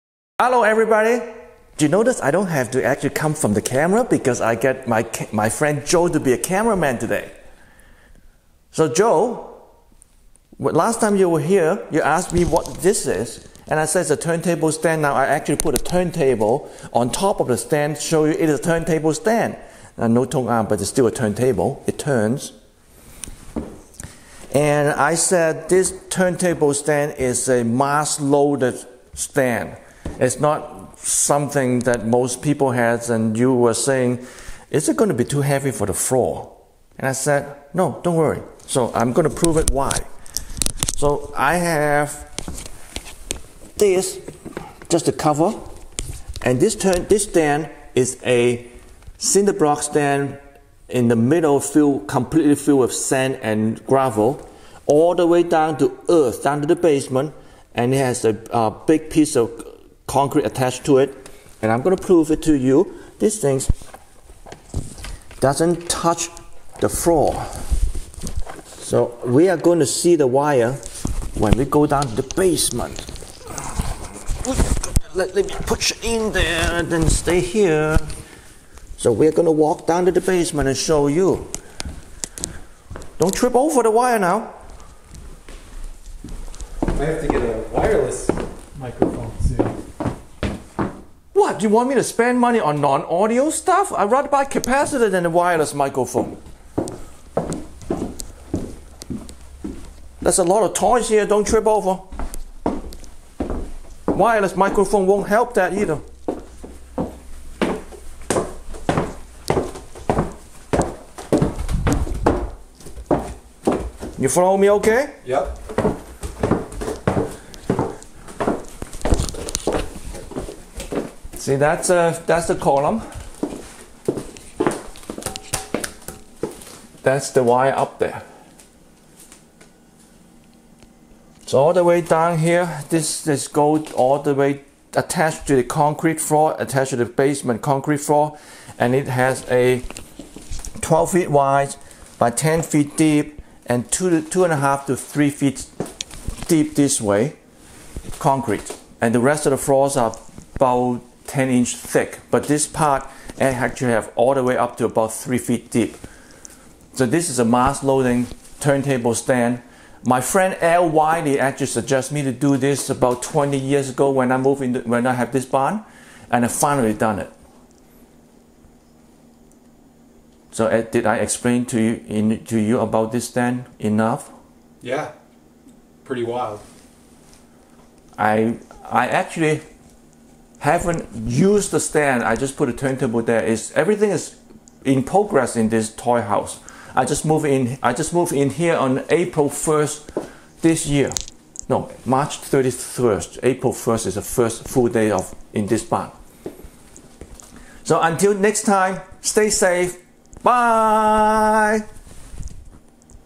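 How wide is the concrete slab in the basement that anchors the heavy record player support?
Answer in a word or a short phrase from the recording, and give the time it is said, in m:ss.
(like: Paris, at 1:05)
12 feet, at 2:20.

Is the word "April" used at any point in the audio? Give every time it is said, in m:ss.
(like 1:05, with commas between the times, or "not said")
3:09, 3:13.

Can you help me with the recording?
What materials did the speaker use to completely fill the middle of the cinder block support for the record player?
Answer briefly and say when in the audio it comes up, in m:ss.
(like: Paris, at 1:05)
Sand and gravel, at 0:52.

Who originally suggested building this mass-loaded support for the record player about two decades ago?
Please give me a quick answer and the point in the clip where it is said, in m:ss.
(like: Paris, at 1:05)
L. Wiley, at 2:40.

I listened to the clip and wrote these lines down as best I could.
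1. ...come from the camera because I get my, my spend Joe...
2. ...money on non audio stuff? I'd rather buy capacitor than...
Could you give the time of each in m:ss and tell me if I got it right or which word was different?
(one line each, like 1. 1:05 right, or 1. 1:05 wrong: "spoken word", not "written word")
1. 0:03 wrong: "friend", not "spend"
2. 1:32 right.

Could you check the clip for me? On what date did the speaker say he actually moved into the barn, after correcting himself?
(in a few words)
March 31st.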